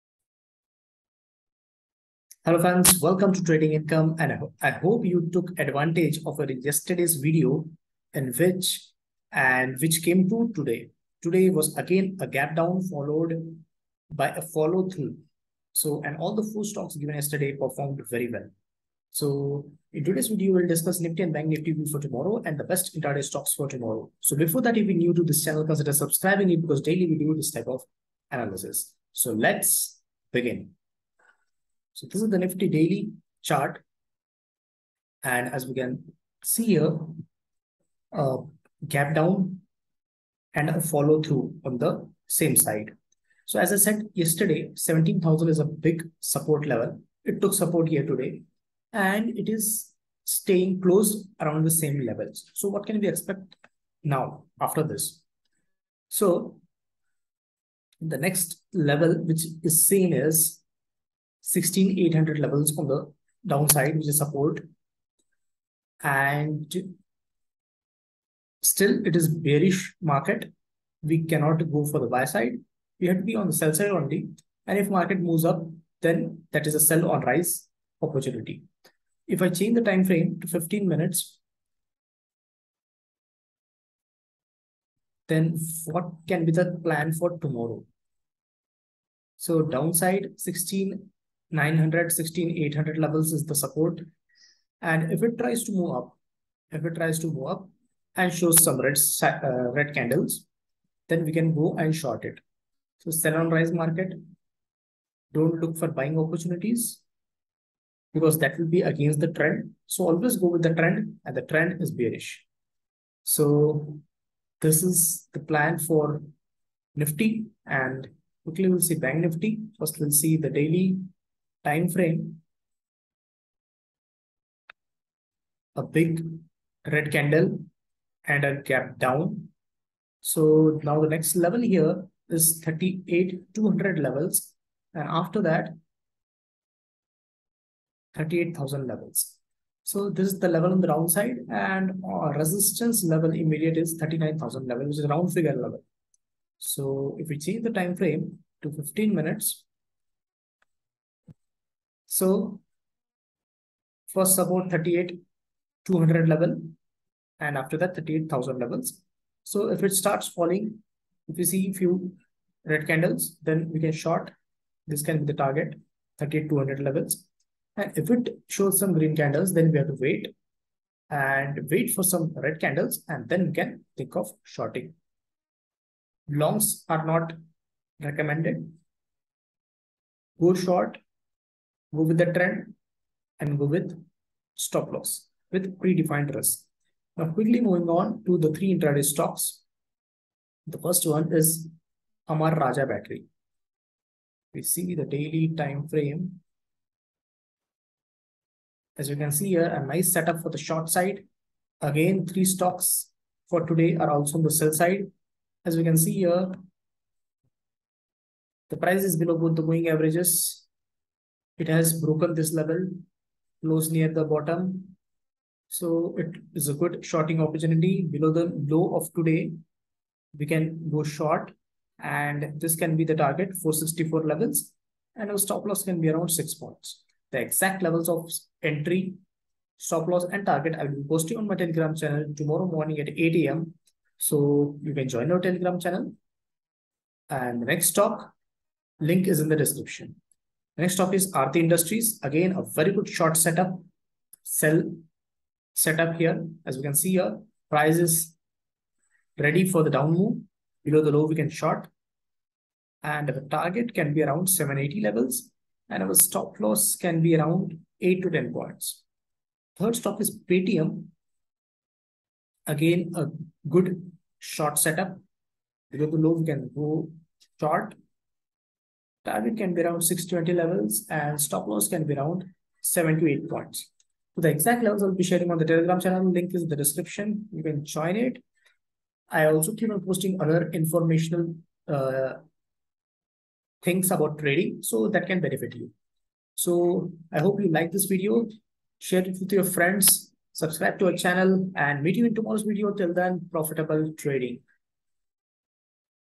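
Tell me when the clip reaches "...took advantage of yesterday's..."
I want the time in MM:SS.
00:05.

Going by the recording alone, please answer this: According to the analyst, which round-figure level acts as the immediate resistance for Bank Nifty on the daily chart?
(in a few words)
39,000.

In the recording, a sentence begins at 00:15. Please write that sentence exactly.
So and all the four stocks given yesterday performed very well.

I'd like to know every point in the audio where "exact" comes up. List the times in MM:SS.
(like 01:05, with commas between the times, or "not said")
03:47, 04:34.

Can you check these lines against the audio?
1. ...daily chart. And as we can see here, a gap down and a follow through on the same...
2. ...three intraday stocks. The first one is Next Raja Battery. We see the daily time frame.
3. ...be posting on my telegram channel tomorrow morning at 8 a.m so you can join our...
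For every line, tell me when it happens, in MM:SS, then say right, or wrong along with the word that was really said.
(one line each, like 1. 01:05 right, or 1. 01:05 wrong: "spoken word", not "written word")
1. 00:32 right
2. 03:08 wrong: "Amara", not "Next"
3. 03:51 right.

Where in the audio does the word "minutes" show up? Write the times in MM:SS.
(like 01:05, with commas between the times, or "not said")
01:20, 02:29.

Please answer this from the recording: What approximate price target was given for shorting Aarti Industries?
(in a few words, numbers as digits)
780.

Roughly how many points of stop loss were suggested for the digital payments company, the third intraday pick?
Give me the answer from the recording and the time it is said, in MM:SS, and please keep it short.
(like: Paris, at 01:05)
7 to 8 points, at 04:32.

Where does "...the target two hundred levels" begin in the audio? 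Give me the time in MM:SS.
02:45.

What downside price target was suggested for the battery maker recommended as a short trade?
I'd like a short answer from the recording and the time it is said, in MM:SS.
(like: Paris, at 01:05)
464, at 03:43.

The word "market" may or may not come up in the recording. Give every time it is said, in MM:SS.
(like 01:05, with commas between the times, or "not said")
01:10, 01:14, 01:43.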